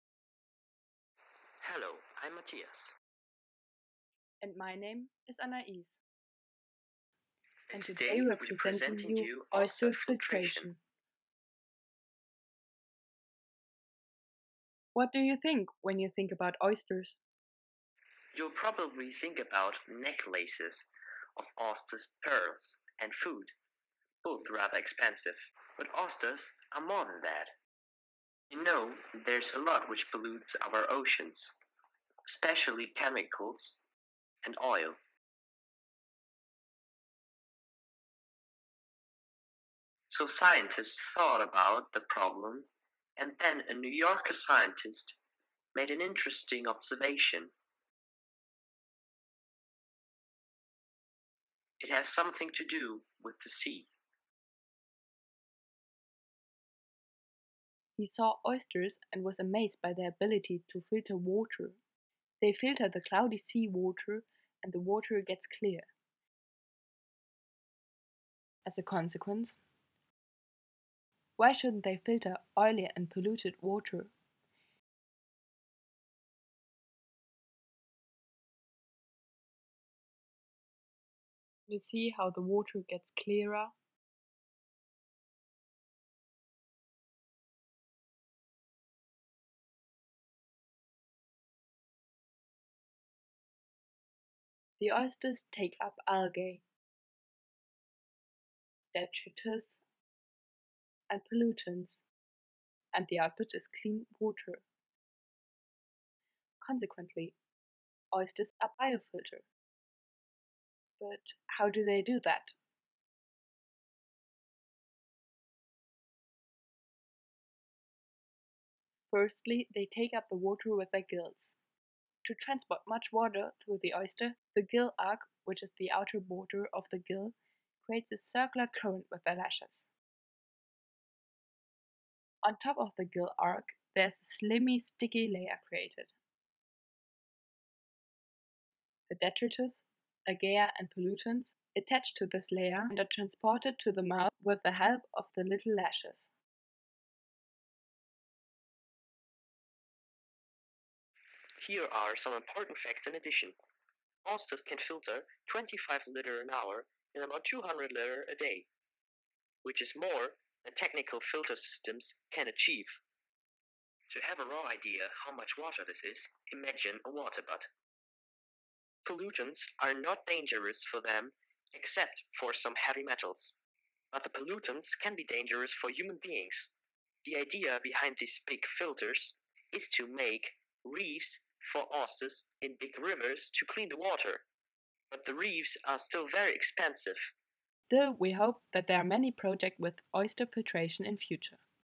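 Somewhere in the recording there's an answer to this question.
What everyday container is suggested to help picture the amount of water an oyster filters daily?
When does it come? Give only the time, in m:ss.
2:47.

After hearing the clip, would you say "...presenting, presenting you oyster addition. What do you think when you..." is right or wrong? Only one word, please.
wrong.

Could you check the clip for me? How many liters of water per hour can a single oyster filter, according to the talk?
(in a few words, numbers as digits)
25.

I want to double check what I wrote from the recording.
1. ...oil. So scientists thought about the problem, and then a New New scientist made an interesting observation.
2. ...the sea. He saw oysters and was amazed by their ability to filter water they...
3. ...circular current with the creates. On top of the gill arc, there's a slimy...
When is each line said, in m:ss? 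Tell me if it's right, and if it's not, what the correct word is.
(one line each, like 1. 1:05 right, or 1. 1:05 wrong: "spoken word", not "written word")
1. 0:34 wrong: "Yorker", not "New"
2. 0:53 right
3. 2:08 wrong: "lashes", not "creates".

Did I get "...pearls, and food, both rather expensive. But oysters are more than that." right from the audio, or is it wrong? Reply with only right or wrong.
right.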